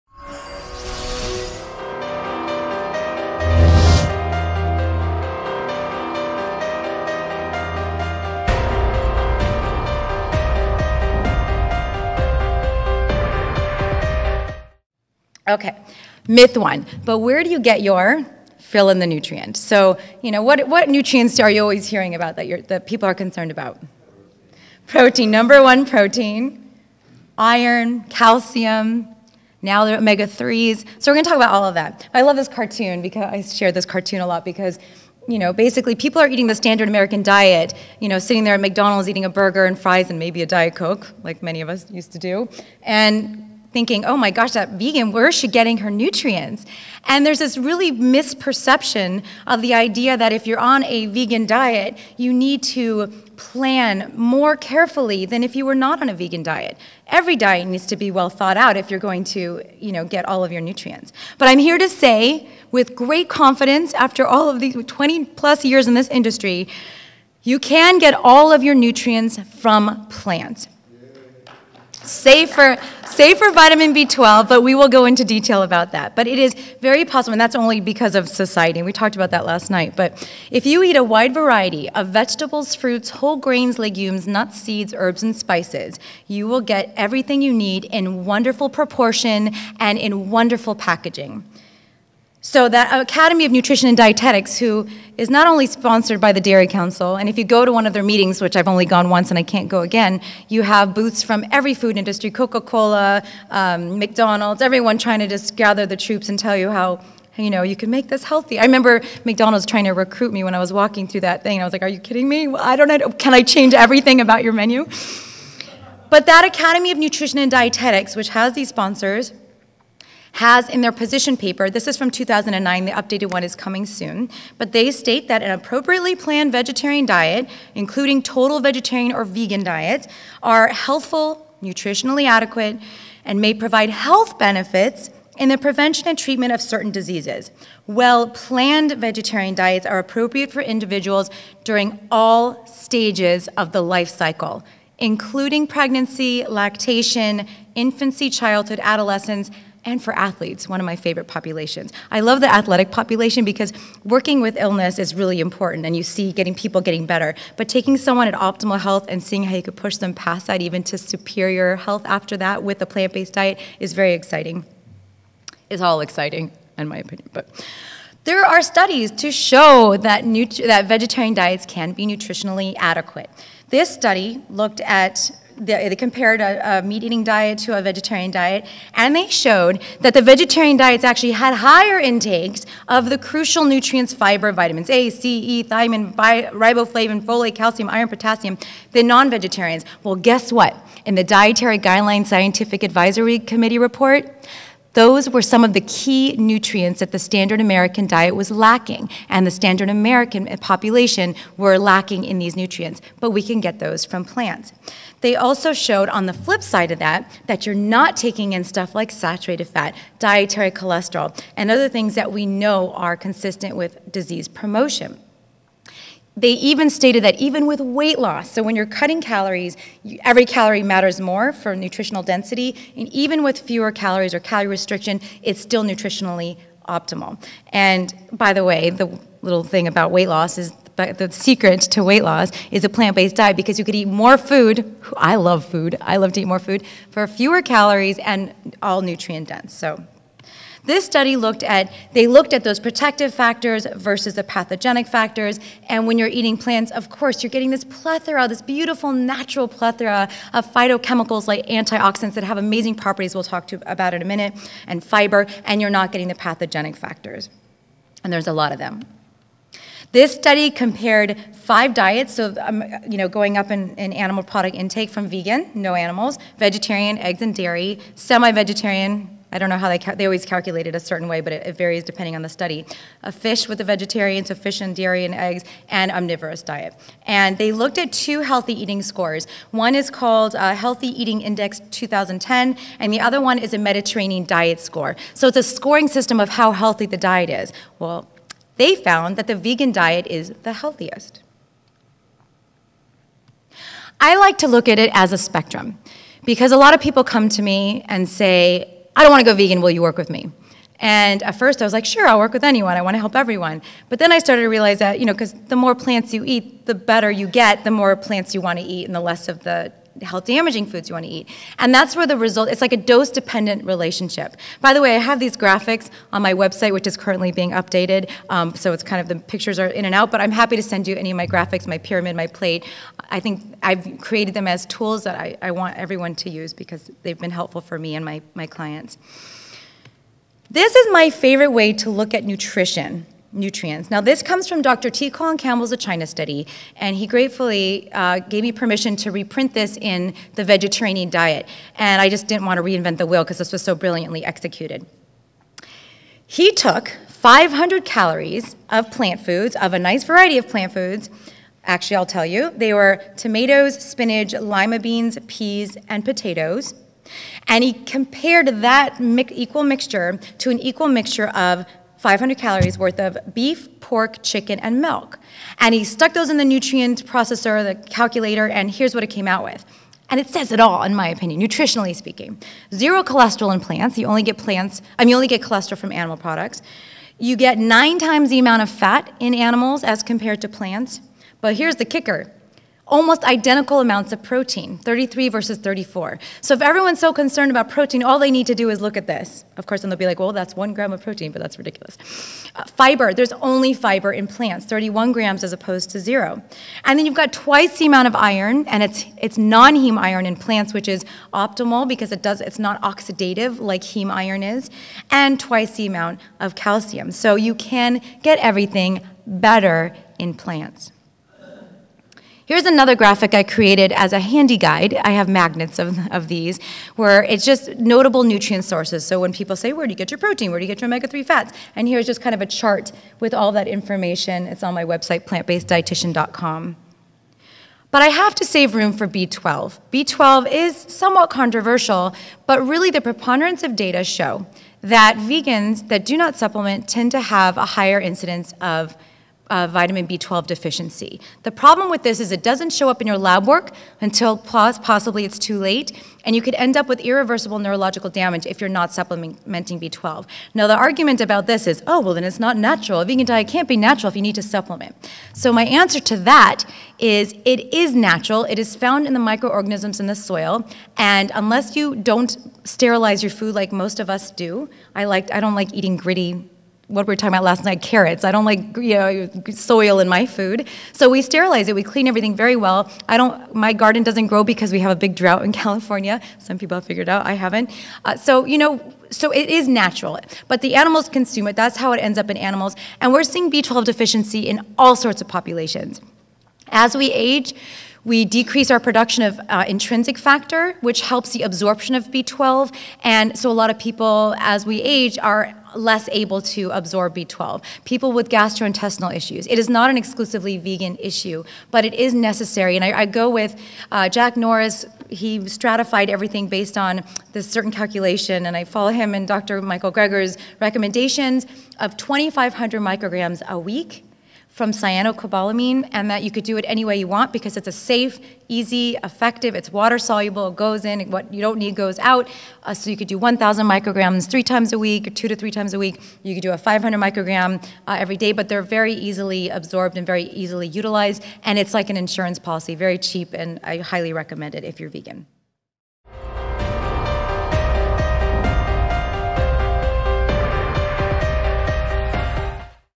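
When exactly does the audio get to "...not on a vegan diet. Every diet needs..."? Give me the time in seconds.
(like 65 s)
55 s.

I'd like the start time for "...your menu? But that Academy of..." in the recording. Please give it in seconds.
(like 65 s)
114 s.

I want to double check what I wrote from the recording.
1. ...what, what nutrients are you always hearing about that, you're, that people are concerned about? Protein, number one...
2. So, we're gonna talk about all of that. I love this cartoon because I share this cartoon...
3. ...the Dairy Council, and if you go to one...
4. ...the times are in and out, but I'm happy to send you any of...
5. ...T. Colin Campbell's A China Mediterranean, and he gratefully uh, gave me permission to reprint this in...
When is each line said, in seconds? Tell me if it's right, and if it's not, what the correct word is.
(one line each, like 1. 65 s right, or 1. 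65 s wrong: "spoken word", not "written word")
1. 20 s right
2. 30 s right
3. 96 s right
4. 319 s wrong: "pictures", not "times"
5. 335 s wrong: "Study", not "Mediterranean".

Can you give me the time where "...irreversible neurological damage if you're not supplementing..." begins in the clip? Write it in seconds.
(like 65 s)
447 s.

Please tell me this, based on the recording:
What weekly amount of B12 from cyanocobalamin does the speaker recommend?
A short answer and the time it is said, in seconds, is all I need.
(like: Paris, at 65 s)
2,500 micrograms, at 512 s.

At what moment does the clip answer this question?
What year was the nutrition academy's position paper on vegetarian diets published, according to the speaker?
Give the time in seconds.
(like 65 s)
122 s.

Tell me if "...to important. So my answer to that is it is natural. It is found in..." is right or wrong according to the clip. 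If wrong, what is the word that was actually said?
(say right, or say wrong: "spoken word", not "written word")
wrong: "supplement", not "important".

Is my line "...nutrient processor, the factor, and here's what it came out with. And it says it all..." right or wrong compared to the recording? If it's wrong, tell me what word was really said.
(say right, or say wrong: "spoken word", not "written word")
wrong: "calculator", not "factor".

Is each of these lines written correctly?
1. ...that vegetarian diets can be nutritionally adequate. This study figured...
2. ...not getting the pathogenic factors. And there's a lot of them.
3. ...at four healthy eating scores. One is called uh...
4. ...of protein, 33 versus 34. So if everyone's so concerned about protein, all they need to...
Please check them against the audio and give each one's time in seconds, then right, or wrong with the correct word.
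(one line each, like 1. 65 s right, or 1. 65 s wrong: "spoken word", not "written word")
1. 170 s wrong: "looked", not "figured"
2. 255 s right
3. 277 s wrong: "two", not "four"
4. 384 s right.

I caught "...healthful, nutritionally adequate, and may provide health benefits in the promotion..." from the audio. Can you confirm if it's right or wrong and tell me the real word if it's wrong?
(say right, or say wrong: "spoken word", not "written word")
wrong: "prevention", not "promotion".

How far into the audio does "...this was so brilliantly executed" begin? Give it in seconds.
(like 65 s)
343 s.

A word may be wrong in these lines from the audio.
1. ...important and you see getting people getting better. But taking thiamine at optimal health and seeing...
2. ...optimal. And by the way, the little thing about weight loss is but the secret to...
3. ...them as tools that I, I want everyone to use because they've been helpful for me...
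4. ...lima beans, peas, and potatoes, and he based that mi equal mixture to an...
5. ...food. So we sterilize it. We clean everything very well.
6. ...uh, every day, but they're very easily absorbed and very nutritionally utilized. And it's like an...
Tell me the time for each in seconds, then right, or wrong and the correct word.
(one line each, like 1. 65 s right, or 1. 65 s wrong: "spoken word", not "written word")
1. 155 s wrong: "someone", not "thiamine"
2. 226 s right
3. 324 s right
4. 354 s wrong: "compared", not "based"
5. 470 s right
6. 528 s wrong: "easily", not "nutritionally".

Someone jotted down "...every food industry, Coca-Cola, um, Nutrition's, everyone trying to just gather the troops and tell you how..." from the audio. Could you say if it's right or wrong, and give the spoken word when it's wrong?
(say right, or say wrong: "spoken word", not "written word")
wrong: "McDonald", not "Nutrition".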